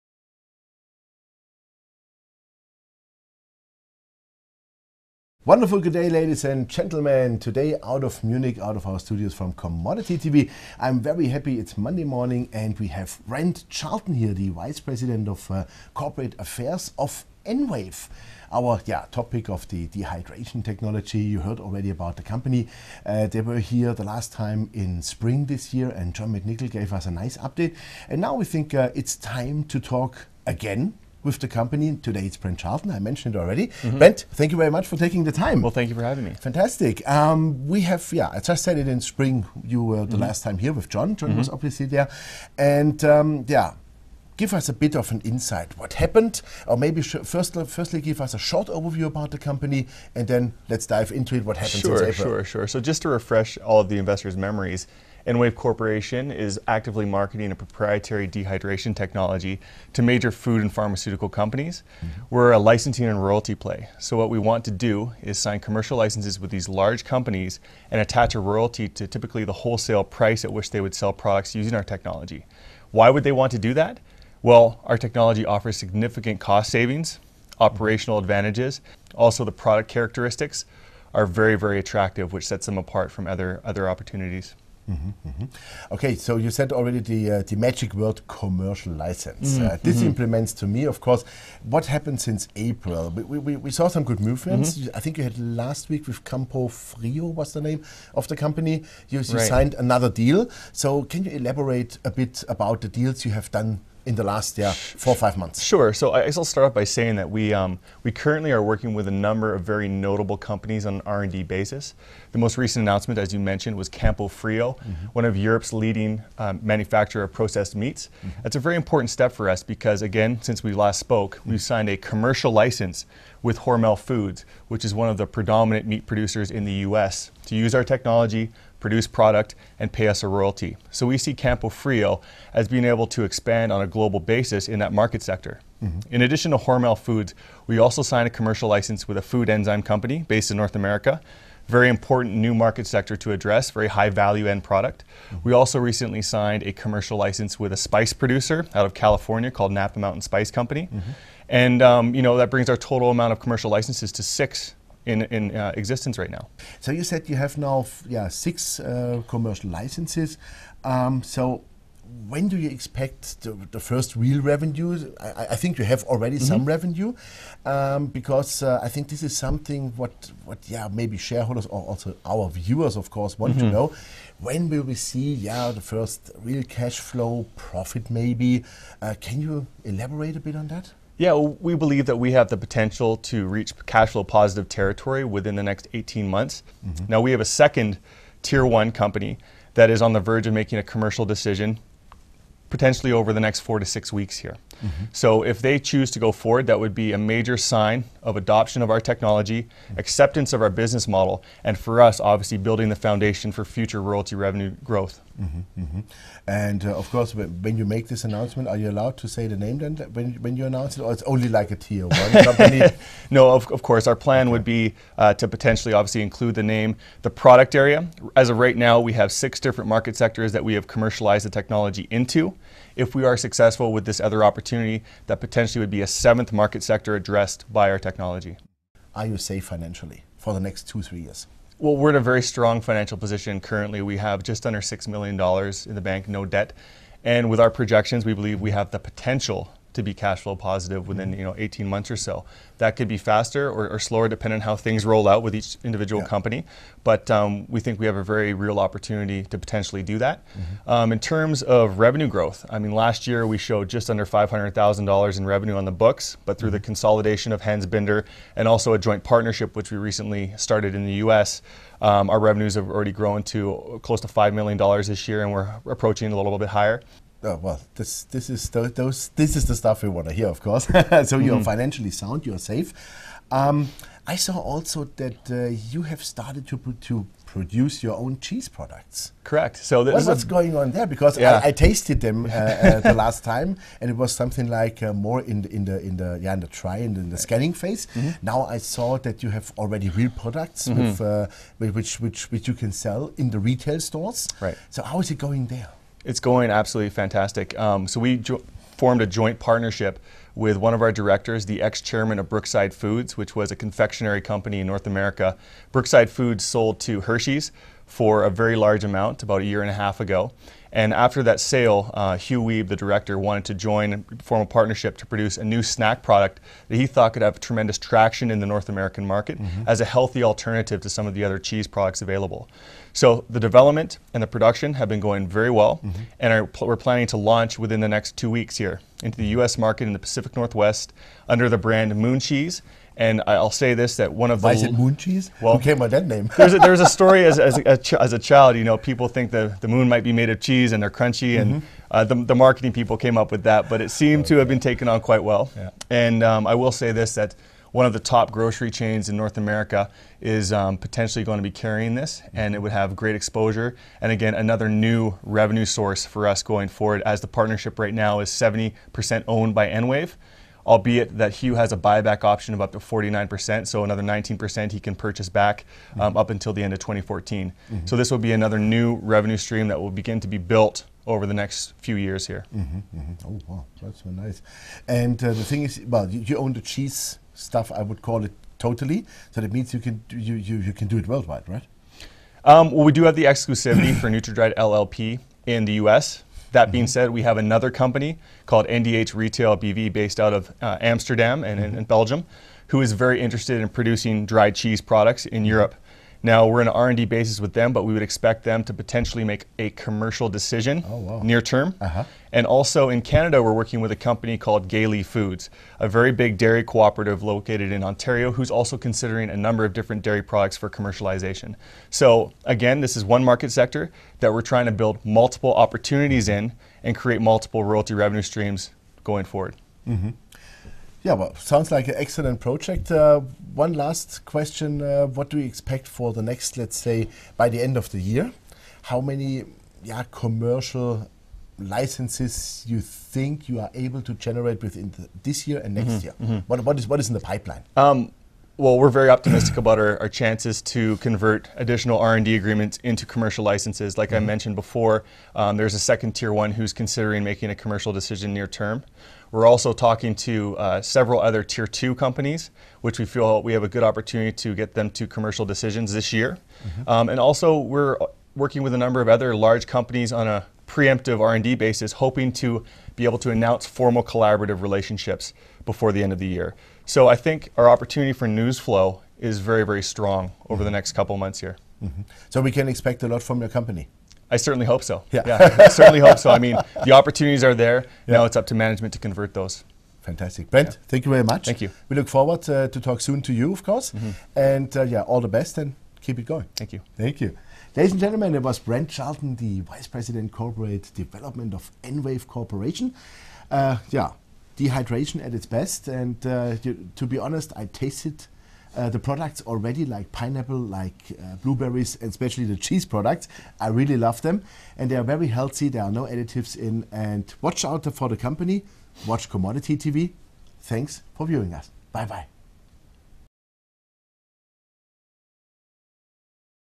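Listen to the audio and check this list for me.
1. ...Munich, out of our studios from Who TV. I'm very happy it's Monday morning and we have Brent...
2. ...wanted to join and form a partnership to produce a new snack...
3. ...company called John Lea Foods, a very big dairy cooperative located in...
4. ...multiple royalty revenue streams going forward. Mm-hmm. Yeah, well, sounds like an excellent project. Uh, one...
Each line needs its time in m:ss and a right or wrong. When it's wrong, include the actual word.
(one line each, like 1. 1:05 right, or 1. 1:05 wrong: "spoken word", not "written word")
1. 0:08 wrong: "Commodity", not "Who"
2. 5:13 right
3. 6:44 wrong: "Gay", not "John"
4. 6:57 right.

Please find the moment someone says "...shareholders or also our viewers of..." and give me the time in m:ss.
2:51.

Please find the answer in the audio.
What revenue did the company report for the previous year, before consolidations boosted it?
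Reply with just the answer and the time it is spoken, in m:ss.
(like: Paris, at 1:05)
just under $500,000, at 4:13.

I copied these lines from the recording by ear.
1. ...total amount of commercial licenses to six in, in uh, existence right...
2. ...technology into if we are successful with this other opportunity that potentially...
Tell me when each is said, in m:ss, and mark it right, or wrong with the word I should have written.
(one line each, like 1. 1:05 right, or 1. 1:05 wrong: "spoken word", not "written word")
1. 2:32 right
2. 3:41 right.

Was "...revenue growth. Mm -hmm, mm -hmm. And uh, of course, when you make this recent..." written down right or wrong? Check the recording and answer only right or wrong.
wrong.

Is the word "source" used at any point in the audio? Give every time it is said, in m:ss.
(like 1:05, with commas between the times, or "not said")
5:55.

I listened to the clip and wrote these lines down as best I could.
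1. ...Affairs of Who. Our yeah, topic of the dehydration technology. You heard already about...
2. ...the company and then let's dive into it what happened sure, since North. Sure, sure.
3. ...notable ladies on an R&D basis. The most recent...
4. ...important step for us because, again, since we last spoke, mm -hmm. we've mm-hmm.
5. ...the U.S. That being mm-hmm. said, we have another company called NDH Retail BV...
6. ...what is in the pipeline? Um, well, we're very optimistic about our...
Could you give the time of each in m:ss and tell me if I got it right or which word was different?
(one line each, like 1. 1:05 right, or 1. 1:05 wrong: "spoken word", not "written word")
1. 0:16 wrong: "EnWave", not "Who"
2. 0:49 wrong: "April", not "North"
3. 1:49 wrong: "companies", not "ladies"
4. 1:58 right
5. 6:25 right
6. 7:17 right.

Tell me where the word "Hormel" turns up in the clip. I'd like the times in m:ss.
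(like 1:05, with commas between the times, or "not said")
2:03, 2:16.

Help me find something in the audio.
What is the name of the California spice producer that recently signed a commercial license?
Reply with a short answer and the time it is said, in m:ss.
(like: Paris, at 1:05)
Napa Mountain Spice Company, at 2:29.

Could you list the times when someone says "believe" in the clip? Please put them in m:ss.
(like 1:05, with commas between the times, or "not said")
3:01, 3:58.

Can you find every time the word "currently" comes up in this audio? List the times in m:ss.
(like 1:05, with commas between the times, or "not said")
1:48, 3:53.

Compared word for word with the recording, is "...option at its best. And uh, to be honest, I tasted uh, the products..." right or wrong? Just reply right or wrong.
wrong.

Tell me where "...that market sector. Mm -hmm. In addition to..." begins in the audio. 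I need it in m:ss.
2:14.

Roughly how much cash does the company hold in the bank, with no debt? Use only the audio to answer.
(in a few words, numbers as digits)
just under $6 million.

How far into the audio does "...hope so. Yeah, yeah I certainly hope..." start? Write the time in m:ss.
7:54.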